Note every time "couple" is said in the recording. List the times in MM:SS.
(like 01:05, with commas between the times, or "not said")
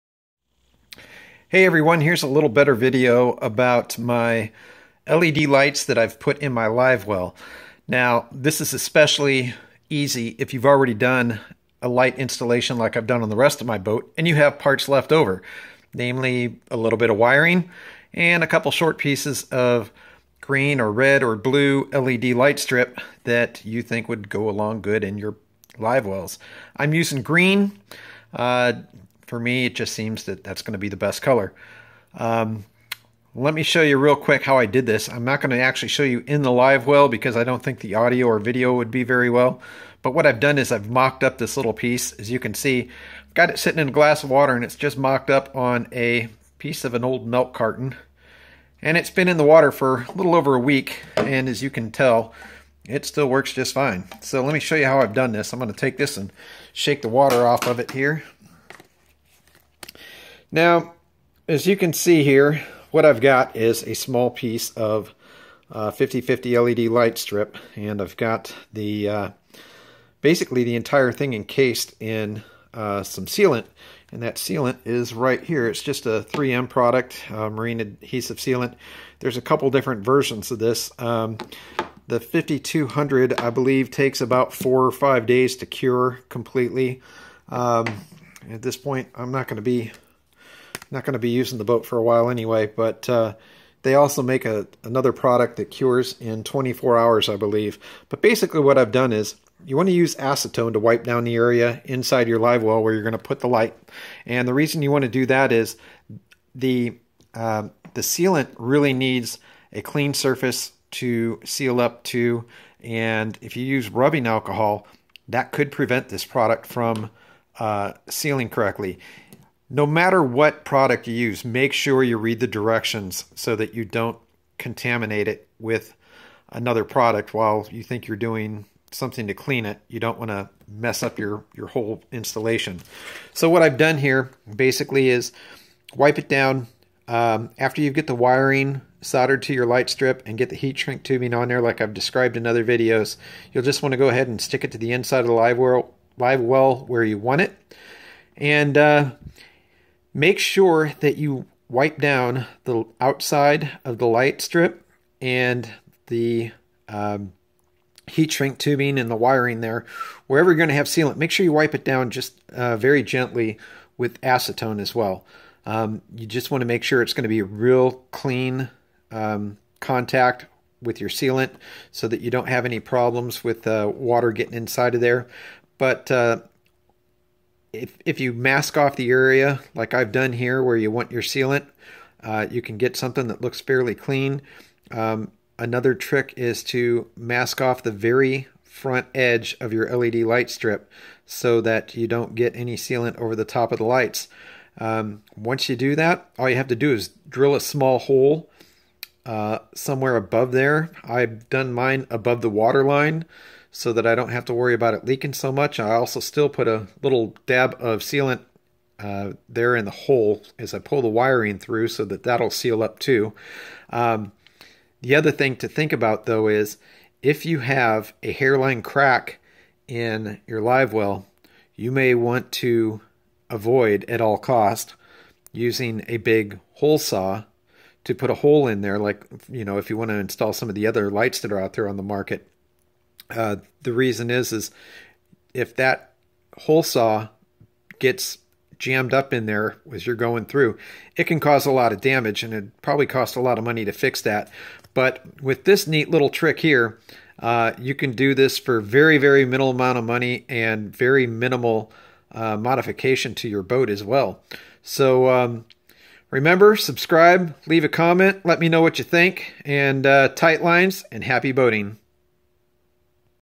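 00:18, 01:19.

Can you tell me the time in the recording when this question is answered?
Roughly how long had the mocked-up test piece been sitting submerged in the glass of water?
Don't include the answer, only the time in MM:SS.
00:50.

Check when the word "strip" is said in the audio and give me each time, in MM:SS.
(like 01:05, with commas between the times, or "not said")
00:22, 01:07, 02:19, 02:34, 03:10.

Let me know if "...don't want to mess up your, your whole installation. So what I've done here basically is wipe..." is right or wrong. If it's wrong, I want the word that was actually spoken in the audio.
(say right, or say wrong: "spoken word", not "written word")
right.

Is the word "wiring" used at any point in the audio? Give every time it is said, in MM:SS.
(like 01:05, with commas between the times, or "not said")
00:17, 02:18, 02:39, 03:31.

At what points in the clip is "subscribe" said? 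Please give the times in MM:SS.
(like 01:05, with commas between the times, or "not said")
04:16.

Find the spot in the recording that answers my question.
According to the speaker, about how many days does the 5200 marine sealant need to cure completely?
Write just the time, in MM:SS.
01:24.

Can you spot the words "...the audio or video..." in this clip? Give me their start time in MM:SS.
00:37.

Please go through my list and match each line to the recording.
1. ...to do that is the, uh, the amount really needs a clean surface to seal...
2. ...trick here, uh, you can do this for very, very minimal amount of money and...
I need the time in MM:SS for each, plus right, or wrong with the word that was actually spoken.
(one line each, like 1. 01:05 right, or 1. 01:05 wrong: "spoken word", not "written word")
1. 01:45 wrong: "sealant", not "amount"
2. 04:06 right.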